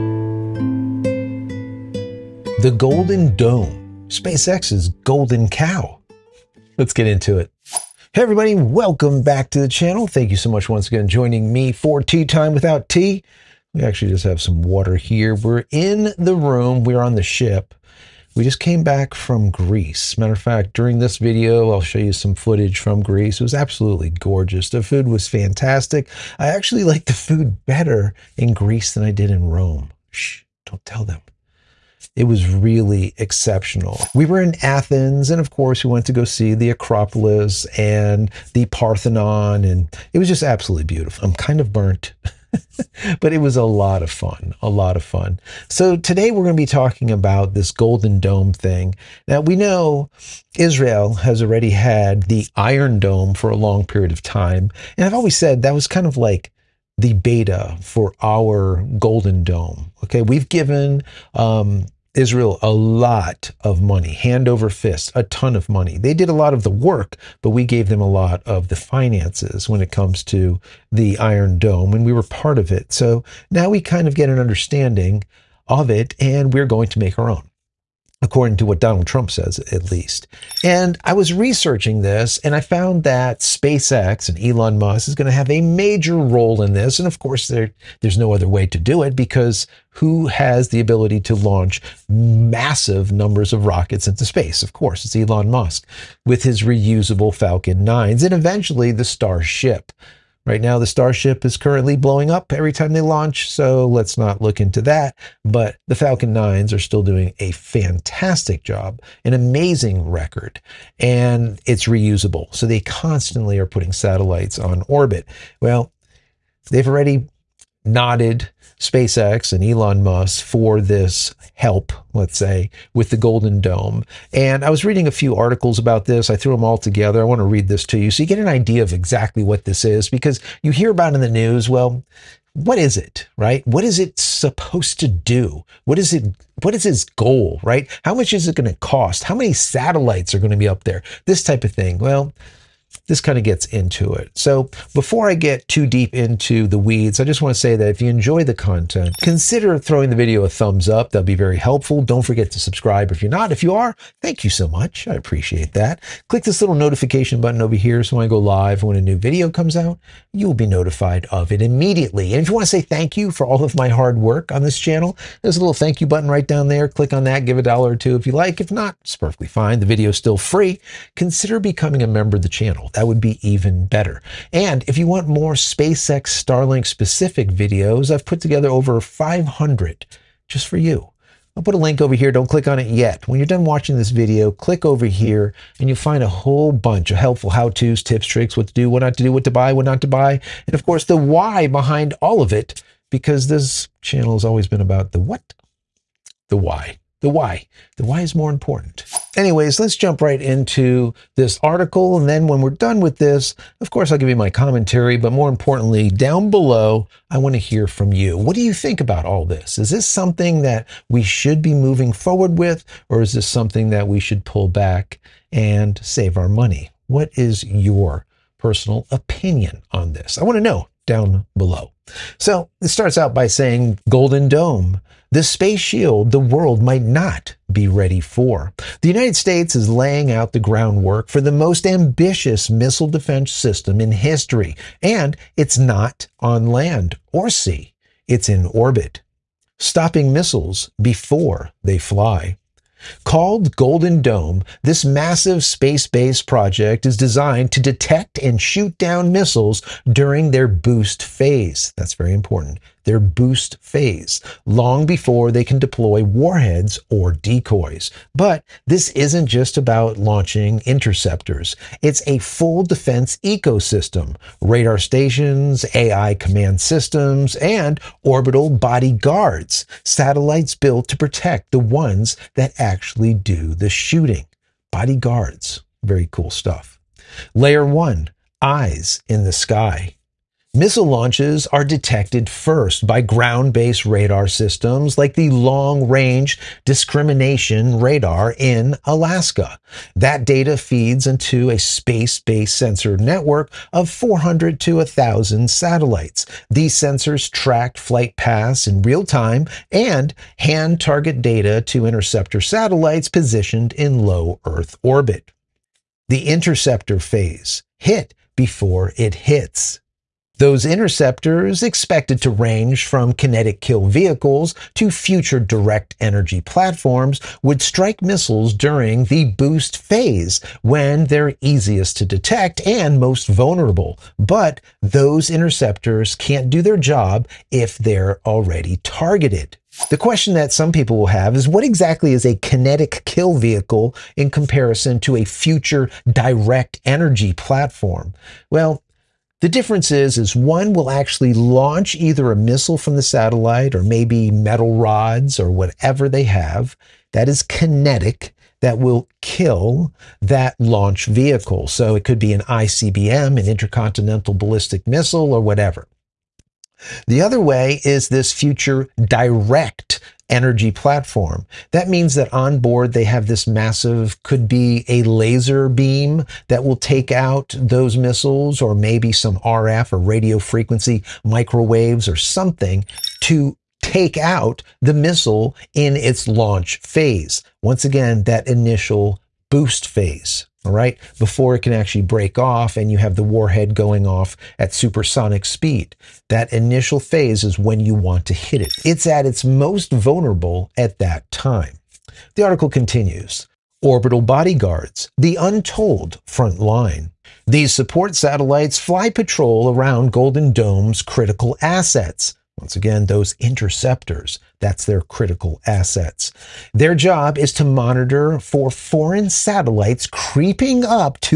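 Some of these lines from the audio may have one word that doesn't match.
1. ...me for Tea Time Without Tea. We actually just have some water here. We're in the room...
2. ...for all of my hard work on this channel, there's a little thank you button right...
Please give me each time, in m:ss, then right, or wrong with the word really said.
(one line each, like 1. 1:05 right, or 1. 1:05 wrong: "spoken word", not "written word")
1. 0:11 right
2. 2:43 right.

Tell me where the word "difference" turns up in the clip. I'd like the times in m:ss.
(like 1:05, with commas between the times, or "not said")
5:39.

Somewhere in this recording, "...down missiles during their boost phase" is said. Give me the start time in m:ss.
4:08.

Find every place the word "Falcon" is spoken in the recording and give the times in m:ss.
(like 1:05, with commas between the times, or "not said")
1:37, 1:45.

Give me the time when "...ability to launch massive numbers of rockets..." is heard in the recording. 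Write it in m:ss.
1:30.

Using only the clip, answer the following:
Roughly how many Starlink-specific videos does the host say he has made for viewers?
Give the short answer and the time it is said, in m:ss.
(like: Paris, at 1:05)
500, at 2:58.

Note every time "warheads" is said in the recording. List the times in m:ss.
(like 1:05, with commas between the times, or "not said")
4:16, 6:23.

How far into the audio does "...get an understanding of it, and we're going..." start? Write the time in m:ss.
1:14.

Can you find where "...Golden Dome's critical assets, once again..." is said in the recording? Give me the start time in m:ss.
6:40.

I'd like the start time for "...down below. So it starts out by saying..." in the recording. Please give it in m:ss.
3:41.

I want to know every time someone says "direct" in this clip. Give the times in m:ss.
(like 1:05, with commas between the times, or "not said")
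5:15, 5:36, 5:59.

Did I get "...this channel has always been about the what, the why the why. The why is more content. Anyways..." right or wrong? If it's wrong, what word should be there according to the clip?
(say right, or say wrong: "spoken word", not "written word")
wrong: "important", not "content".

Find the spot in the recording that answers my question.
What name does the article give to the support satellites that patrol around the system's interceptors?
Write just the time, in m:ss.
6:34.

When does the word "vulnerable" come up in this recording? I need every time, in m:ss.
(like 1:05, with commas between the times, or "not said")
5:23, 6:30.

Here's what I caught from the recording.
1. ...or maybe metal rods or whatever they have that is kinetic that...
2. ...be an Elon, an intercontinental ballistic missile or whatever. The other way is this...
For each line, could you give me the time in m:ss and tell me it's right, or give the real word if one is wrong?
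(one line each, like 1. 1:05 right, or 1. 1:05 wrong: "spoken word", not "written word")
1. 5:43 right
2. 5:52 wrong: "ICBM", not "Elon".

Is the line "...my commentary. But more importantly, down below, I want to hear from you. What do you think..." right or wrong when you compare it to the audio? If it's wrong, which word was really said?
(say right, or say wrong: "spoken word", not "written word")
right.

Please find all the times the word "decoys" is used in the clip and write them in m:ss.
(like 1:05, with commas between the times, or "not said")
4:17.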